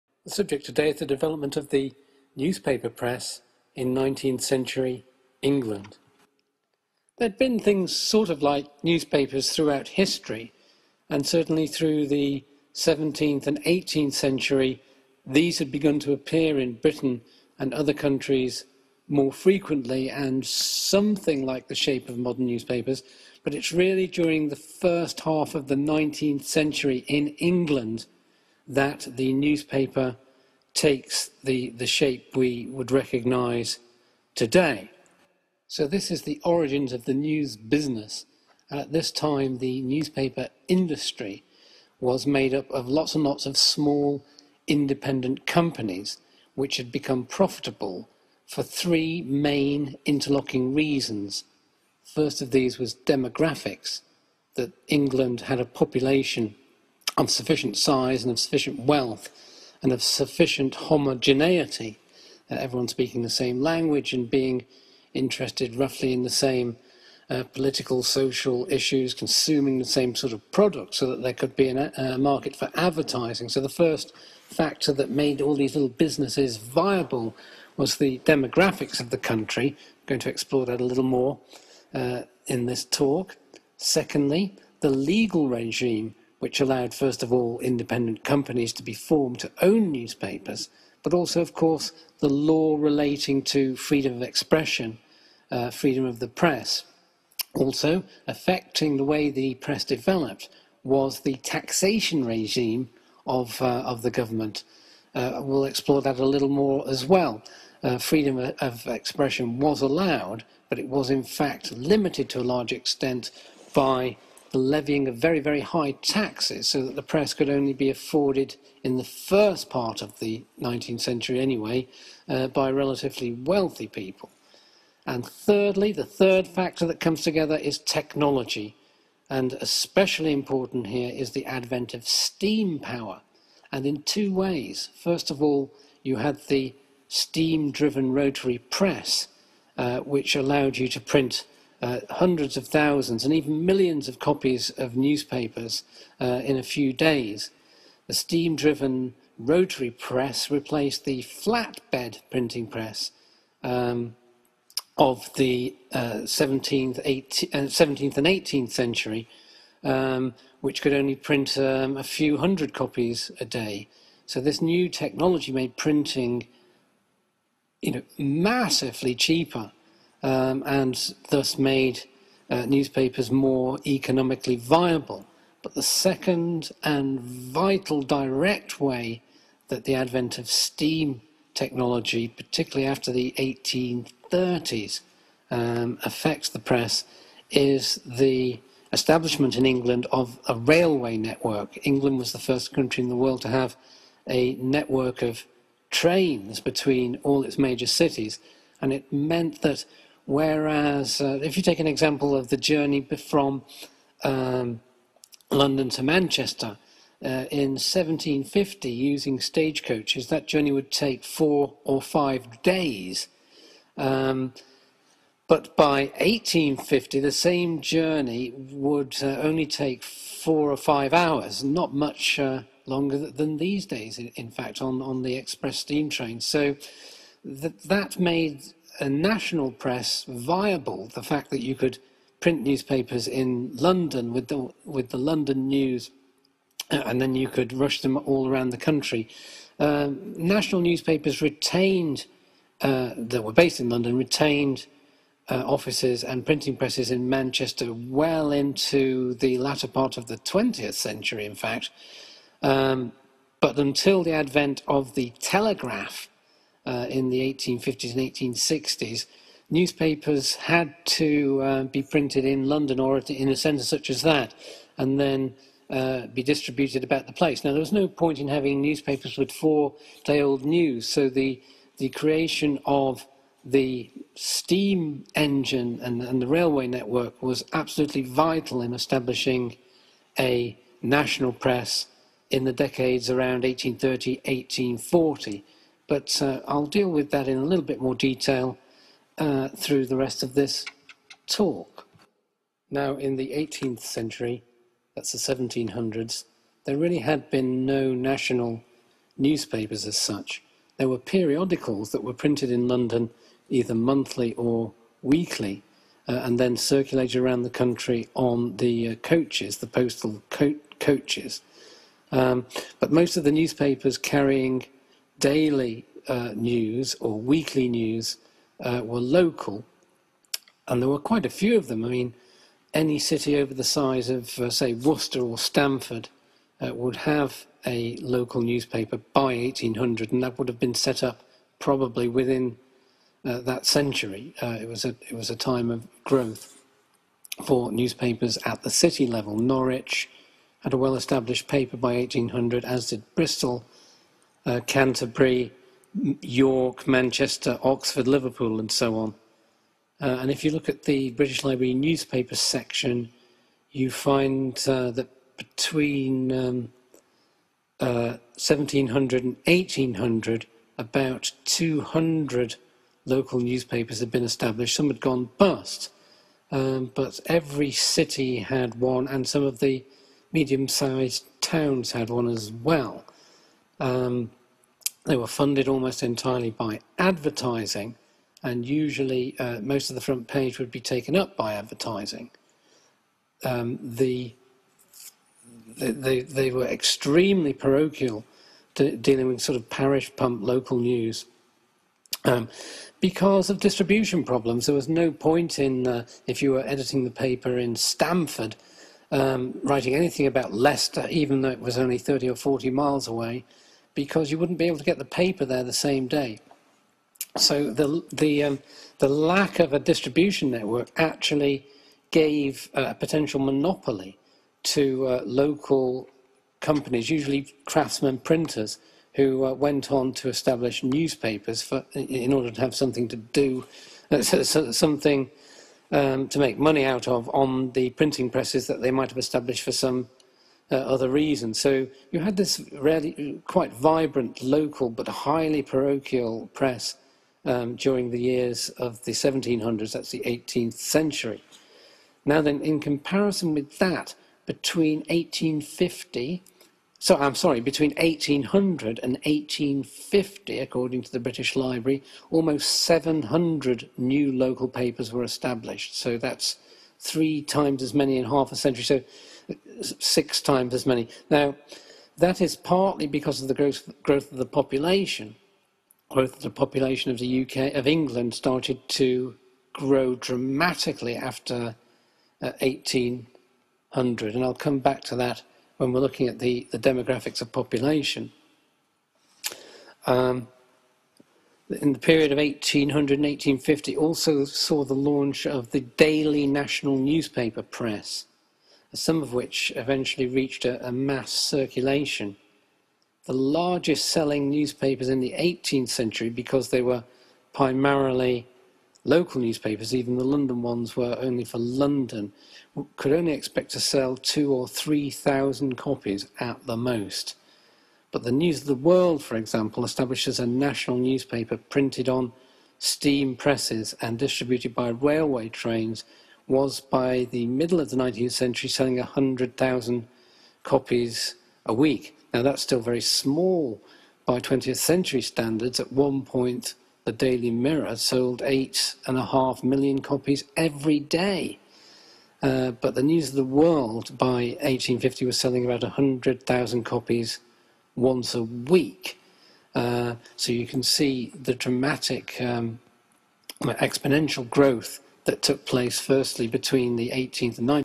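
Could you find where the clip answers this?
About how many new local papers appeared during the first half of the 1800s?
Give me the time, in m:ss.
7:32.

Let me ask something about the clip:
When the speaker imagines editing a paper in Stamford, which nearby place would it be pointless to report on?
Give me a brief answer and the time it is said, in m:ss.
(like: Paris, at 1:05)
Leicester, at 6:40.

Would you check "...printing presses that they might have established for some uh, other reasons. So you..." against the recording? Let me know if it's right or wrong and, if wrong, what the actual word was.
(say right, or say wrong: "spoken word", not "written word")
right.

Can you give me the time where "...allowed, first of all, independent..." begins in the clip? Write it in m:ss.
1:26.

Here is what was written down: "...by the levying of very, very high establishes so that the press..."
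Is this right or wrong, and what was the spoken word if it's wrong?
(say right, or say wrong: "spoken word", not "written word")
wrong: "taxes", not "establishes".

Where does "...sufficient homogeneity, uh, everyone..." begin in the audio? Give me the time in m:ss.
1:00.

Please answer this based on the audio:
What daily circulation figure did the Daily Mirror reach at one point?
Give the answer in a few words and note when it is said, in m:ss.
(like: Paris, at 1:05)
8.5 million, at 8:48.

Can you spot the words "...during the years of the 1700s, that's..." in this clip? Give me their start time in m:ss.
7:17.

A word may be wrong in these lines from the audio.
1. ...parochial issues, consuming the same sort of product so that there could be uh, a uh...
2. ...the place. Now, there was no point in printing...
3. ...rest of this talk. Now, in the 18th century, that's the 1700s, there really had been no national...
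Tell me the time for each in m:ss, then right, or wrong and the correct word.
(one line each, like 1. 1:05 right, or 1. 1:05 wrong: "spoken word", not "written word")
1. 1:08 wrong: "social", not "parochial"
2. 4:27 wrong: "having", not "printing"
3. 4:50 right.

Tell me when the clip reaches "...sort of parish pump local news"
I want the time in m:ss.
6:29.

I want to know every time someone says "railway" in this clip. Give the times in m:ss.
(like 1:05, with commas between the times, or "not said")
3:10, 4:36, 8:35.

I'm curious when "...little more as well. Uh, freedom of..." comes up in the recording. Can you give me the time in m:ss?
1:46.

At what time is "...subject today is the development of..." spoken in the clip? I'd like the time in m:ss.
0:00.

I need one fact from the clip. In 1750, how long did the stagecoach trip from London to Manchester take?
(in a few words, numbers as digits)
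four or five days.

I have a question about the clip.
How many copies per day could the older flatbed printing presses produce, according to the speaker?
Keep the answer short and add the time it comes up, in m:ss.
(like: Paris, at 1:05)
a few hundred, at 2:41.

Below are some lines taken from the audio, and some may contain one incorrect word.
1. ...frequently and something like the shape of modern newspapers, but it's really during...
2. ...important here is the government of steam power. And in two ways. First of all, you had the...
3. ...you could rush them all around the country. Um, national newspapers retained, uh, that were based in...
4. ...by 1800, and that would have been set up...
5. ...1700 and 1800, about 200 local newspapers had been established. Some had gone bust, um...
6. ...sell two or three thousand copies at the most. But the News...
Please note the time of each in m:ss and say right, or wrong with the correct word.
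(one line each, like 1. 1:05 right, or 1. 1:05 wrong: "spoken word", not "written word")
1. 0:19 right
2. 2:10 wrong: "advent", not "government"
3. 3:57 right
4. 5:29 right
5. 5:58 right
6. 8:23 right.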